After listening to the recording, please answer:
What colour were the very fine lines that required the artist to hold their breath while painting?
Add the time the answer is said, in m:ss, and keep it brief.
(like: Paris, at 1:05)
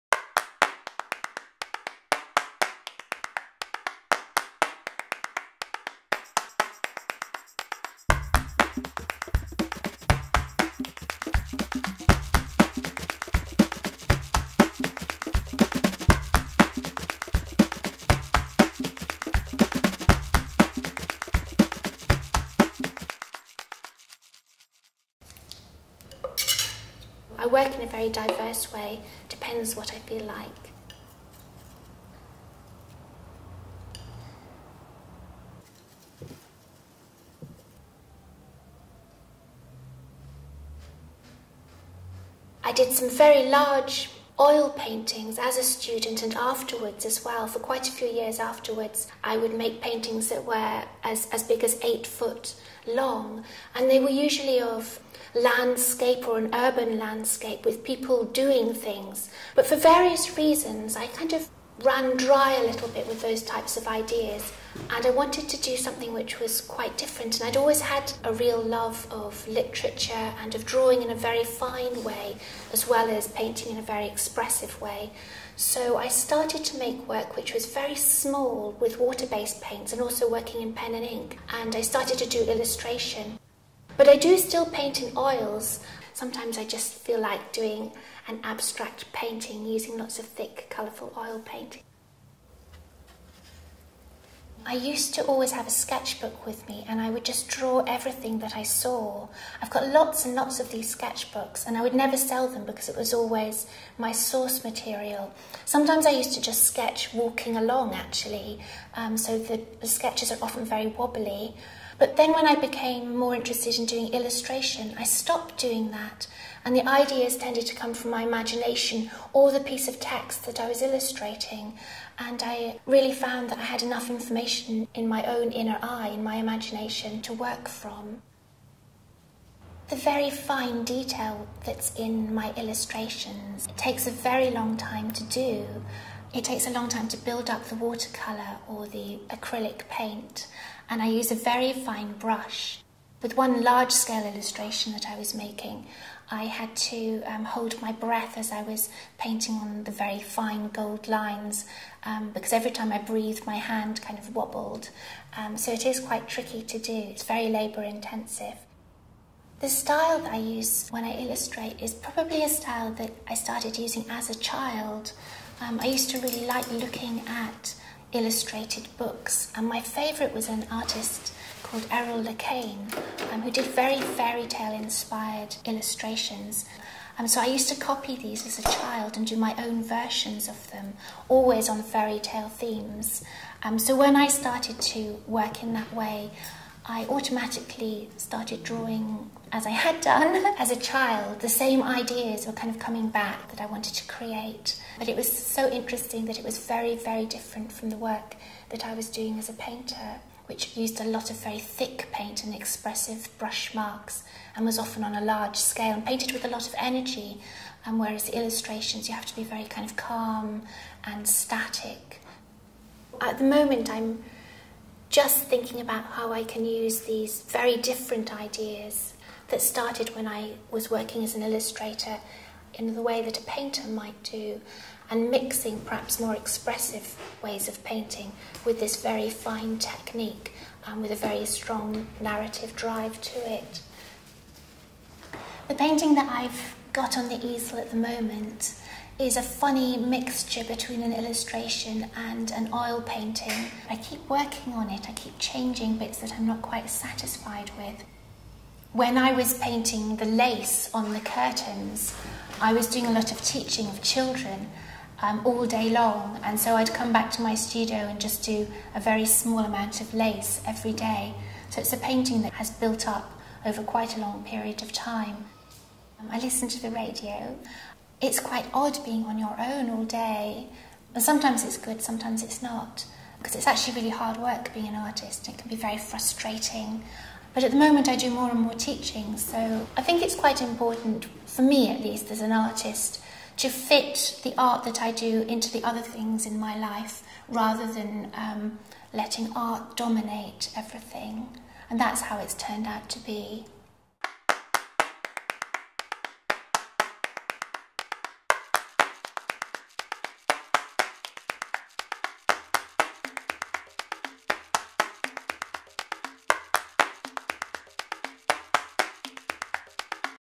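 Gold, at 2:30.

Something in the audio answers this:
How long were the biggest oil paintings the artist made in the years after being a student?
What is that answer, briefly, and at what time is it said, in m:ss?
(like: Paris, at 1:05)
8 feet, at 0:51.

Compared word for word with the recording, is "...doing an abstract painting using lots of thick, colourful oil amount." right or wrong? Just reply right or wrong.
wrong.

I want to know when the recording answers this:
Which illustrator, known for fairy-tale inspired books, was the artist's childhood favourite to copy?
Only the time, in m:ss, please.
2:51.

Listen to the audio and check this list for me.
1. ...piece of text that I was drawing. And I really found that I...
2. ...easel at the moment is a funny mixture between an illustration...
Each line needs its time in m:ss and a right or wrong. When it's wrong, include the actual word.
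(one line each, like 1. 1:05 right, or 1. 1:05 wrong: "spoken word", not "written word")
1. 1:59 wrong: "illustrating", not "drawing"
2. 3:57 right.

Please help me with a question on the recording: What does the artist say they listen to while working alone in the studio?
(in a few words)
The radio.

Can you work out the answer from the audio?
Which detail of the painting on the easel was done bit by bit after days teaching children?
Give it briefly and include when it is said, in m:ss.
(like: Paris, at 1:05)
The lace on the curtains, at 4:10.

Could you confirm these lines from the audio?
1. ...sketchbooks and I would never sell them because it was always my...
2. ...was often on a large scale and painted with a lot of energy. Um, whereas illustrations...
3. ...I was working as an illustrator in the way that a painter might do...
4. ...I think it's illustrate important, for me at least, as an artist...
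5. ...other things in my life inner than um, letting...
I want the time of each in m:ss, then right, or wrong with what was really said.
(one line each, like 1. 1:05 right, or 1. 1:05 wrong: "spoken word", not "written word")
1. 1:40 right
2. 3:24 right
3. 3:40 right
4. 4:39 wrong: "quite", not "illustrate"
5. 4:45 wrong: "rather", not "inner".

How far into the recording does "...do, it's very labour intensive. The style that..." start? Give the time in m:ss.
2:36.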